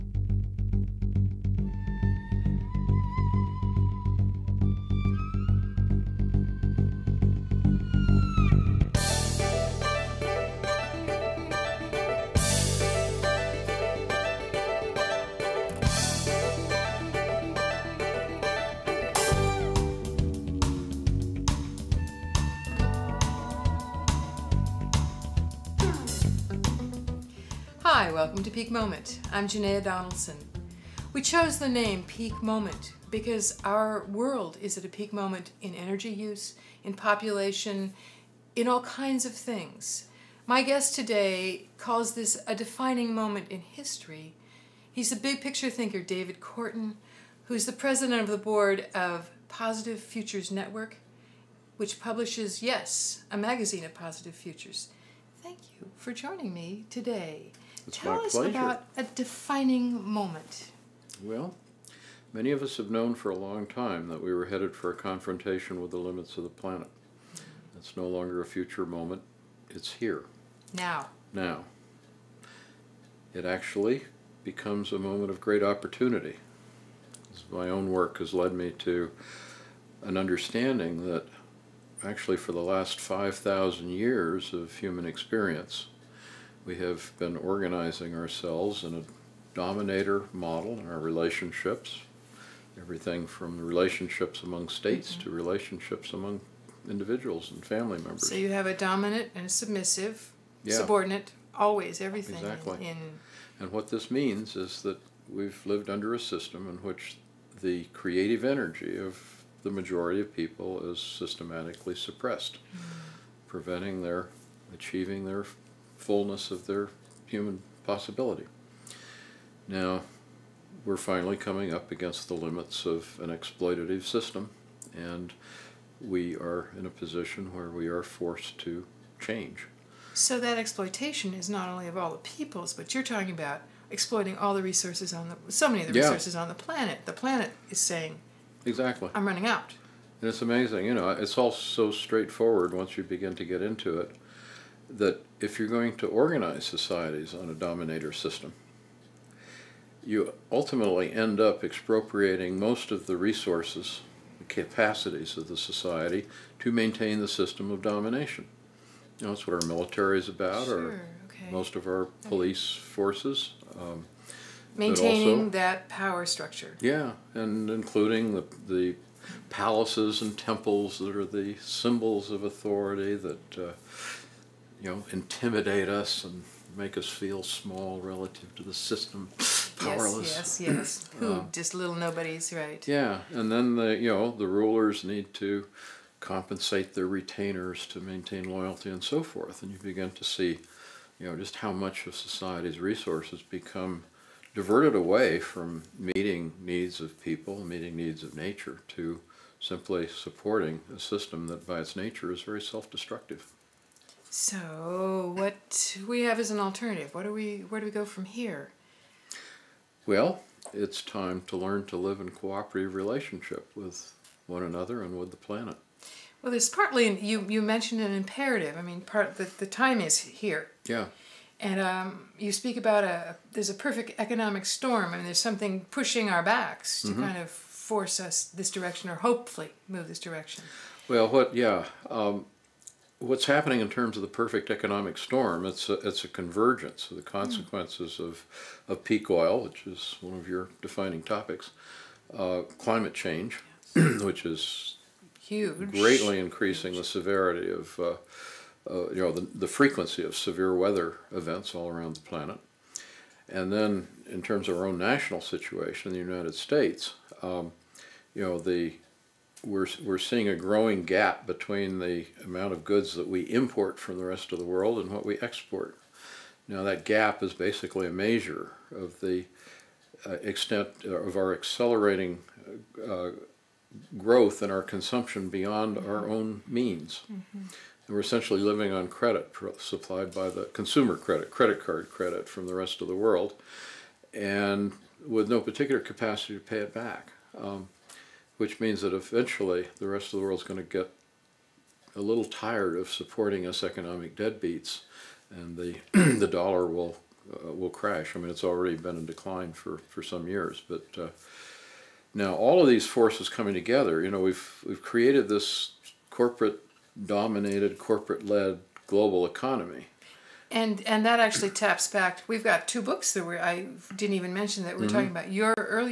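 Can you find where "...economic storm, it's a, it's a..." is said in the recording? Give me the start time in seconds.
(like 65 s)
234 s.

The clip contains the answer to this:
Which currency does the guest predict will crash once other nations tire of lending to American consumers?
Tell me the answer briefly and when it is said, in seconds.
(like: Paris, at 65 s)
the dollar, at 296 s.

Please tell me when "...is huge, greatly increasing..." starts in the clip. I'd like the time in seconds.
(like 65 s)
244 s.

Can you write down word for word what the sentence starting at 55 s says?
Thank you for joining me today.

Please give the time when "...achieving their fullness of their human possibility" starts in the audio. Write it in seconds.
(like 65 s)
114 s.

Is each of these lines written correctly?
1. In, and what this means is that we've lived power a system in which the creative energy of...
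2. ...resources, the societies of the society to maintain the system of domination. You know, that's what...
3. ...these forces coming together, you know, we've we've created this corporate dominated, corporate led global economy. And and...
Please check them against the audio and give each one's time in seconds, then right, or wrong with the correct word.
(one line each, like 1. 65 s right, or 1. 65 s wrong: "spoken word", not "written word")
1. 102 s wrong: "under", not "power"
2. 153 s wrong: "capacities", not "societies"
3. 302 s right.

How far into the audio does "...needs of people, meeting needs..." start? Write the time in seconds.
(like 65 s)
196 s.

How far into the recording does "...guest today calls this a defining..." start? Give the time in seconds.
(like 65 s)
40 s.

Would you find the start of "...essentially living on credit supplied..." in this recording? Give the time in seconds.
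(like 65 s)
278 s.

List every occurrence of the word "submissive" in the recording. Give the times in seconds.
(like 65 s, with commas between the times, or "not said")
99 s.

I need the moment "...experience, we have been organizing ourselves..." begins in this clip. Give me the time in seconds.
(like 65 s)
85 s.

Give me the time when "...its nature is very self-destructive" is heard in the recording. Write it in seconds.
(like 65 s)
201 s.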